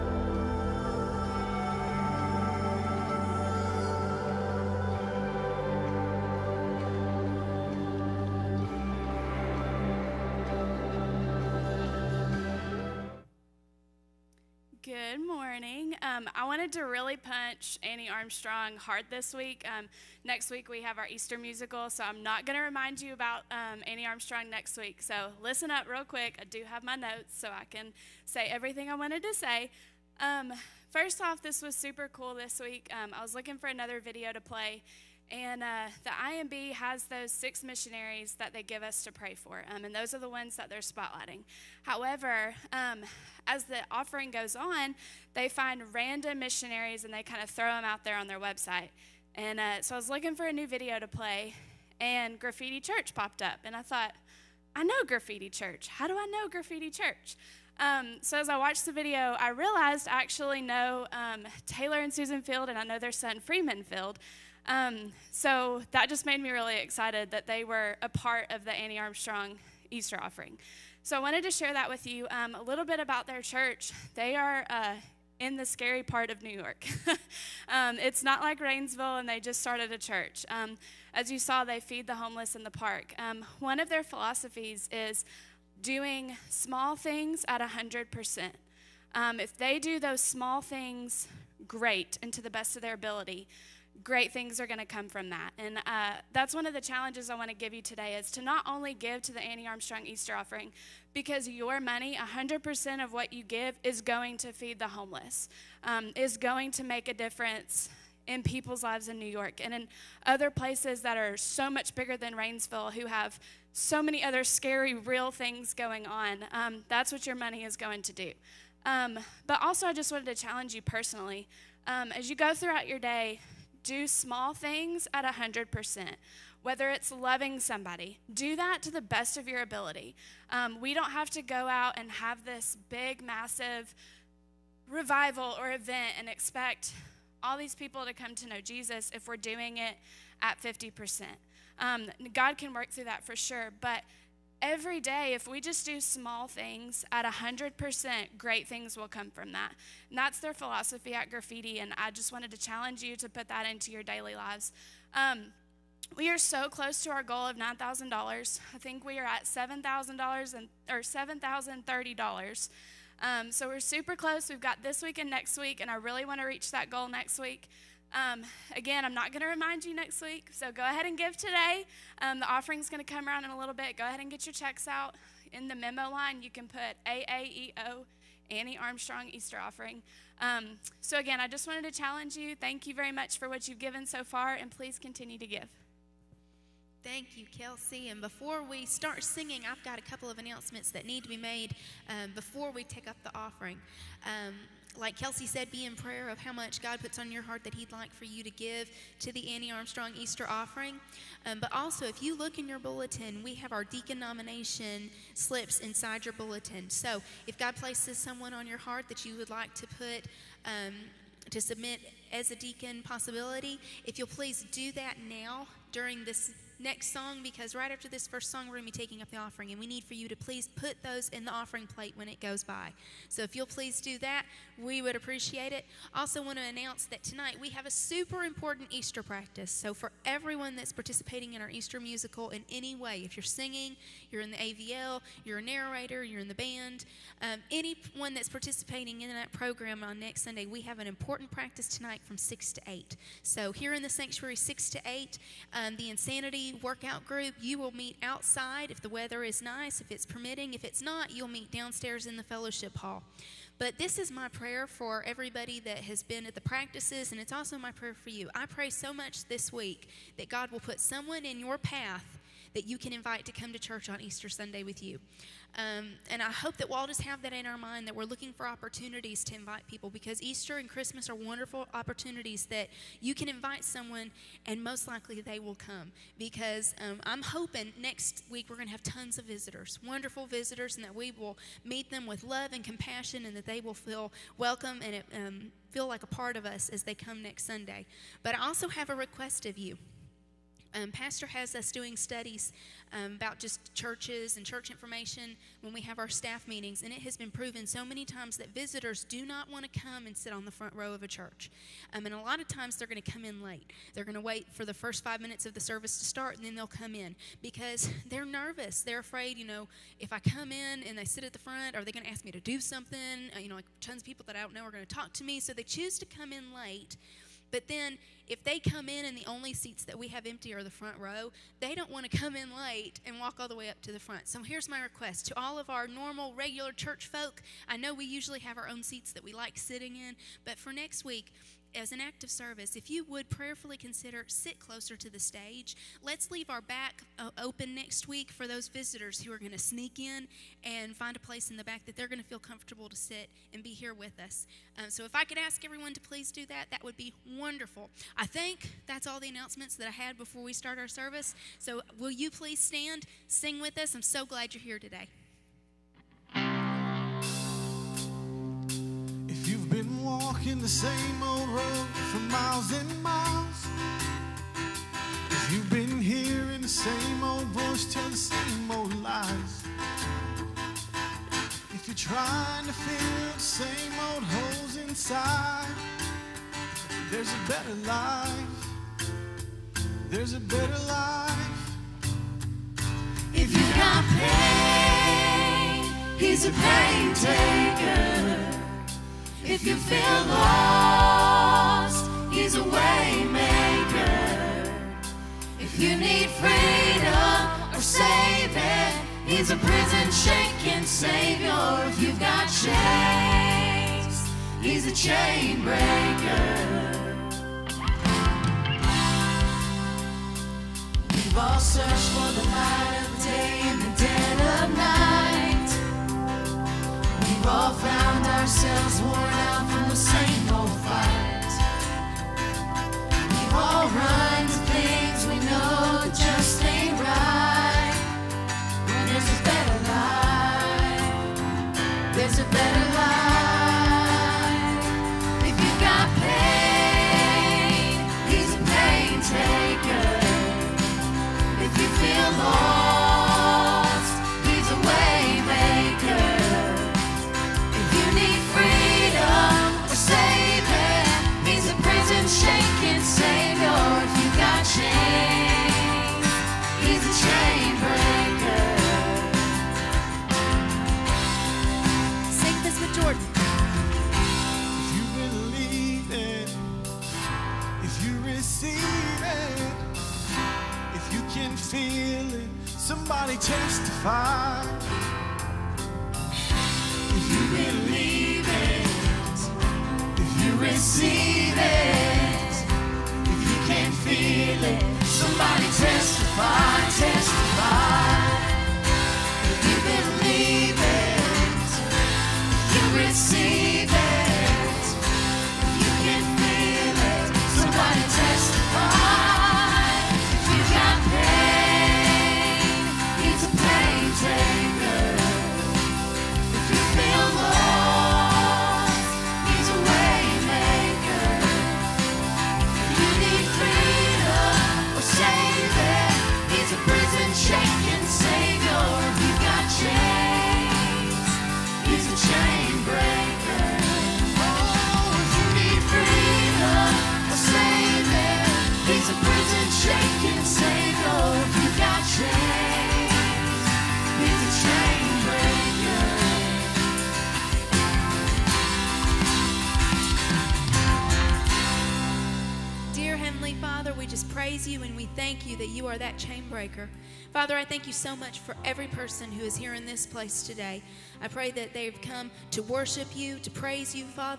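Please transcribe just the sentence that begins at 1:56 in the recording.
Um, that's what your money is going to do.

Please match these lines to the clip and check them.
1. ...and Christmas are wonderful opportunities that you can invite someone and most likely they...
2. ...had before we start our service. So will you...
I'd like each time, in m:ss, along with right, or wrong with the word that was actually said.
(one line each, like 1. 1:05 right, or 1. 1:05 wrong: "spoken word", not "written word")
1. 4:30 right
2. 5:50 right.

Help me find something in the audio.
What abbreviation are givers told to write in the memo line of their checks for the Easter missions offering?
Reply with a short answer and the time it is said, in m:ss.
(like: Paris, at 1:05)
AAEO, at 2:57.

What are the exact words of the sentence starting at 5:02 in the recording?
Um, and a lot of times they're going to come in late.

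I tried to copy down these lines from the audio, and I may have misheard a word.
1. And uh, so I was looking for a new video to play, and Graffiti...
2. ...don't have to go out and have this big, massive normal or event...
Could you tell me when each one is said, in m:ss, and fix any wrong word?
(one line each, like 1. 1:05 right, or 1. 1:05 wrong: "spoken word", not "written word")
1. 0:49 right
2. 2:10 wrong: "revival", not "normal".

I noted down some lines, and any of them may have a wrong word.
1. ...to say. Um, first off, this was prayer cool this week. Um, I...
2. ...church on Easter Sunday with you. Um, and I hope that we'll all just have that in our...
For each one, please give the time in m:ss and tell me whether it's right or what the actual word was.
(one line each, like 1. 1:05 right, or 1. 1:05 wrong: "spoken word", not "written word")
1. 0:29 wrong: "super", not "prayer"
2. 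4:23 right.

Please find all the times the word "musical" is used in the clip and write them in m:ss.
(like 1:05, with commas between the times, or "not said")
0:21, 3:51.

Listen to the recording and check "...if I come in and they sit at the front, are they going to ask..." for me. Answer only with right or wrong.
right.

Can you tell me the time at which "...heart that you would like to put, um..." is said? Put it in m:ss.
3:28.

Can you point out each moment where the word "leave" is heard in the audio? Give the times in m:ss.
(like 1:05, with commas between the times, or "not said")
5:36.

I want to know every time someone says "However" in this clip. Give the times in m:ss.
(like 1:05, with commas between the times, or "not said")
0:41.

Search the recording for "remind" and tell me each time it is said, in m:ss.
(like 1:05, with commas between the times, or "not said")
0:22, 2:49.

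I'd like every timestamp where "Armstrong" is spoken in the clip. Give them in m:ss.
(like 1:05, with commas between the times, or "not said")
0:18, 0:24, 1:08, 1:39, 2:58, 3:19.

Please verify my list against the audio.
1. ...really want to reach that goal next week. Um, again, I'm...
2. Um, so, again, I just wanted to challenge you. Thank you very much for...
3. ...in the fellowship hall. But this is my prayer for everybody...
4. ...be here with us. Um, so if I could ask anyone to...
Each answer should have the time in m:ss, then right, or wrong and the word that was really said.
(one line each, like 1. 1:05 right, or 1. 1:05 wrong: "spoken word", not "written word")
1. 2:45 right
2. 3:00 right
3. 4:12 right
4. 5:43 wrong: "everyone", not "anyone".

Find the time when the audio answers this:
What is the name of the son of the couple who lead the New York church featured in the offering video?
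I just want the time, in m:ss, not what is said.
1:03.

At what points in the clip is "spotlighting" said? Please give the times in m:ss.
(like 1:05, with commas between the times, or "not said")
0:40.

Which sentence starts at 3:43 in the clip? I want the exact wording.
So if you'll please do that, we would appreciate it.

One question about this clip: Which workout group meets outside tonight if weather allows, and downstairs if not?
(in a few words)
Insanity.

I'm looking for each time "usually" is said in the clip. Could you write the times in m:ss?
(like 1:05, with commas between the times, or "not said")
5:28.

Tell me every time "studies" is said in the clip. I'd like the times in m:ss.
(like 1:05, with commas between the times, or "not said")
4:52.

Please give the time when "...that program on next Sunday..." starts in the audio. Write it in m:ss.
3:59.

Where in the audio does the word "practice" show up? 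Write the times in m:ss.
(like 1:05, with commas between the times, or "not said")
3:49, 4:01, 4:16.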